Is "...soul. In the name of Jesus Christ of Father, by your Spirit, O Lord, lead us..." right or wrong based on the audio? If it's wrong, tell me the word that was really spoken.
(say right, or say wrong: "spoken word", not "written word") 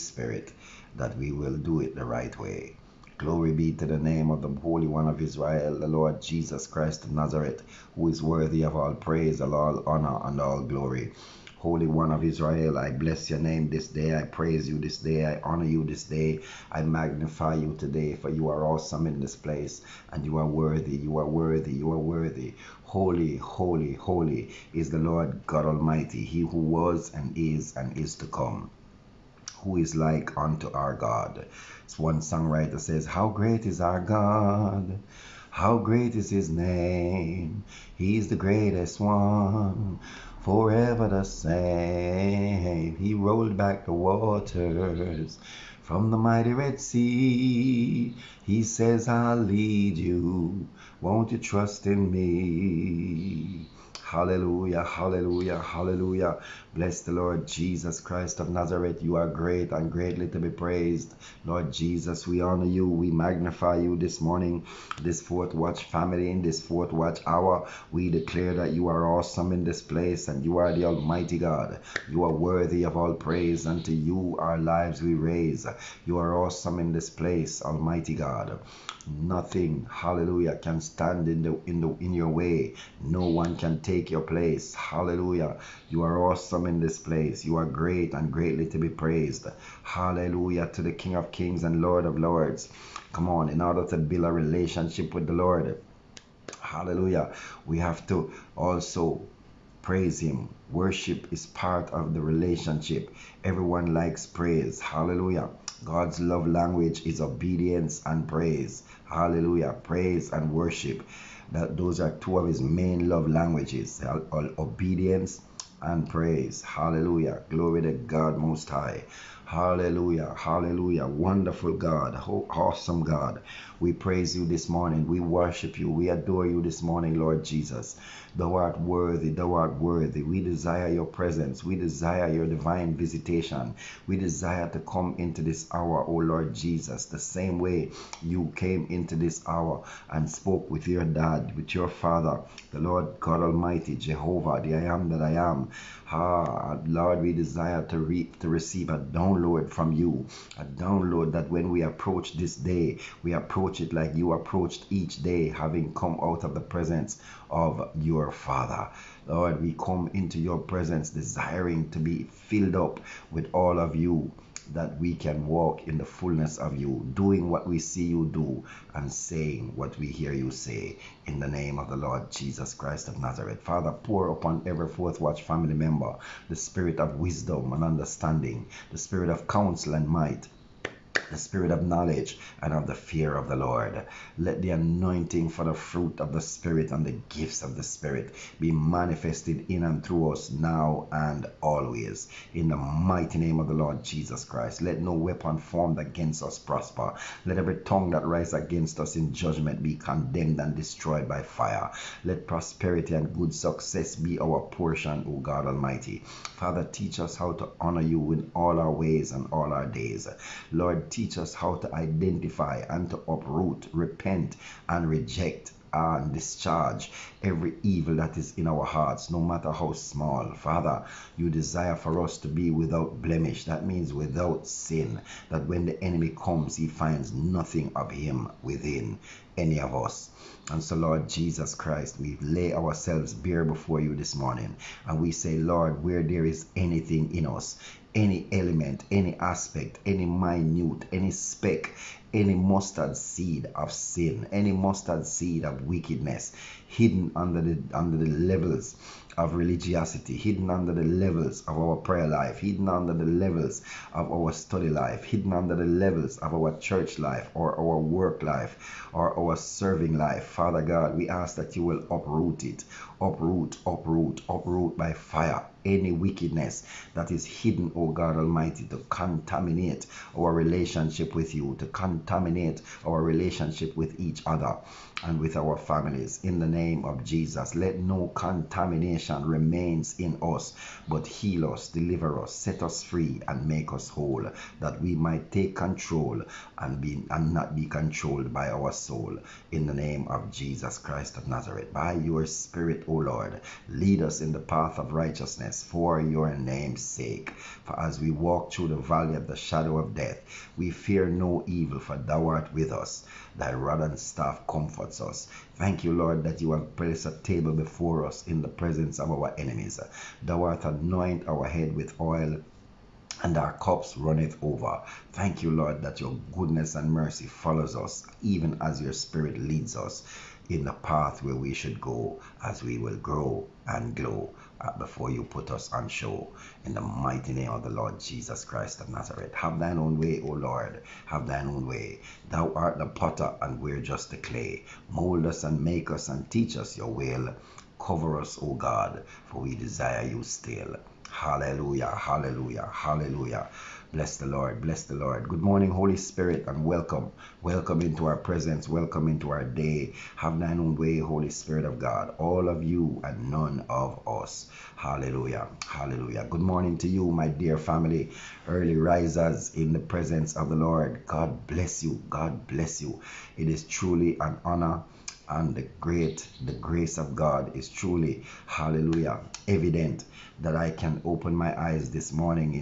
wrong: "Nazareth", not "Father".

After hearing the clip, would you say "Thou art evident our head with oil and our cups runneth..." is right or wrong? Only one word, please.
wrong.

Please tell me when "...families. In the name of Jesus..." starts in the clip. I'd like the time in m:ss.
4:35.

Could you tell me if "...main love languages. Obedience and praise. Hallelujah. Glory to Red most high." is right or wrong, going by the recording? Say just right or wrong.
wrong.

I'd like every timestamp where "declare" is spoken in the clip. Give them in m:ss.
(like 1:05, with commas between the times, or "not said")
1:08.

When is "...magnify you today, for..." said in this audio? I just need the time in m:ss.
0:16.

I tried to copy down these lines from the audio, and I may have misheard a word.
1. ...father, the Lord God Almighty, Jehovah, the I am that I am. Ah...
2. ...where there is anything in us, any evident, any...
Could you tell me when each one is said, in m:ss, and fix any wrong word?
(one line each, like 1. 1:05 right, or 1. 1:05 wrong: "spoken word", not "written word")
1. 2:21 right
2. 3:56 wrong: "element", not "evident".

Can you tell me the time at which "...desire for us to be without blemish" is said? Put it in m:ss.
3:41.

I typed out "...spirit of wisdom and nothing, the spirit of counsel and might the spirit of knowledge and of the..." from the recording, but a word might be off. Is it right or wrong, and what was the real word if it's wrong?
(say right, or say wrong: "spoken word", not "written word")
wrong: "understanding", not "nothing".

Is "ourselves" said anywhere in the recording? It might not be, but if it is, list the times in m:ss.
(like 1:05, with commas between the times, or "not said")
3:52.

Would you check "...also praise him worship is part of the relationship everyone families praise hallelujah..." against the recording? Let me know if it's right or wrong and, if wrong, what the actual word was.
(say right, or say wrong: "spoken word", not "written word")
wrong: "likes", not "families".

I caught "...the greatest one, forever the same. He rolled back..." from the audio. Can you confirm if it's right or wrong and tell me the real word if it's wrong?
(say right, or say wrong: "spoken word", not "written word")
right.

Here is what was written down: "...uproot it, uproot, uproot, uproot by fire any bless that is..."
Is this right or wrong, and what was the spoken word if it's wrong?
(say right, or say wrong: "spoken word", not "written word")
wrong: "wickedness", not "bless".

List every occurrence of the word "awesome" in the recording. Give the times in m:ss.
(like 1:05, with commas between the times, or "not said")
0:18, 1:09, 1:16, 1:26, 2:02.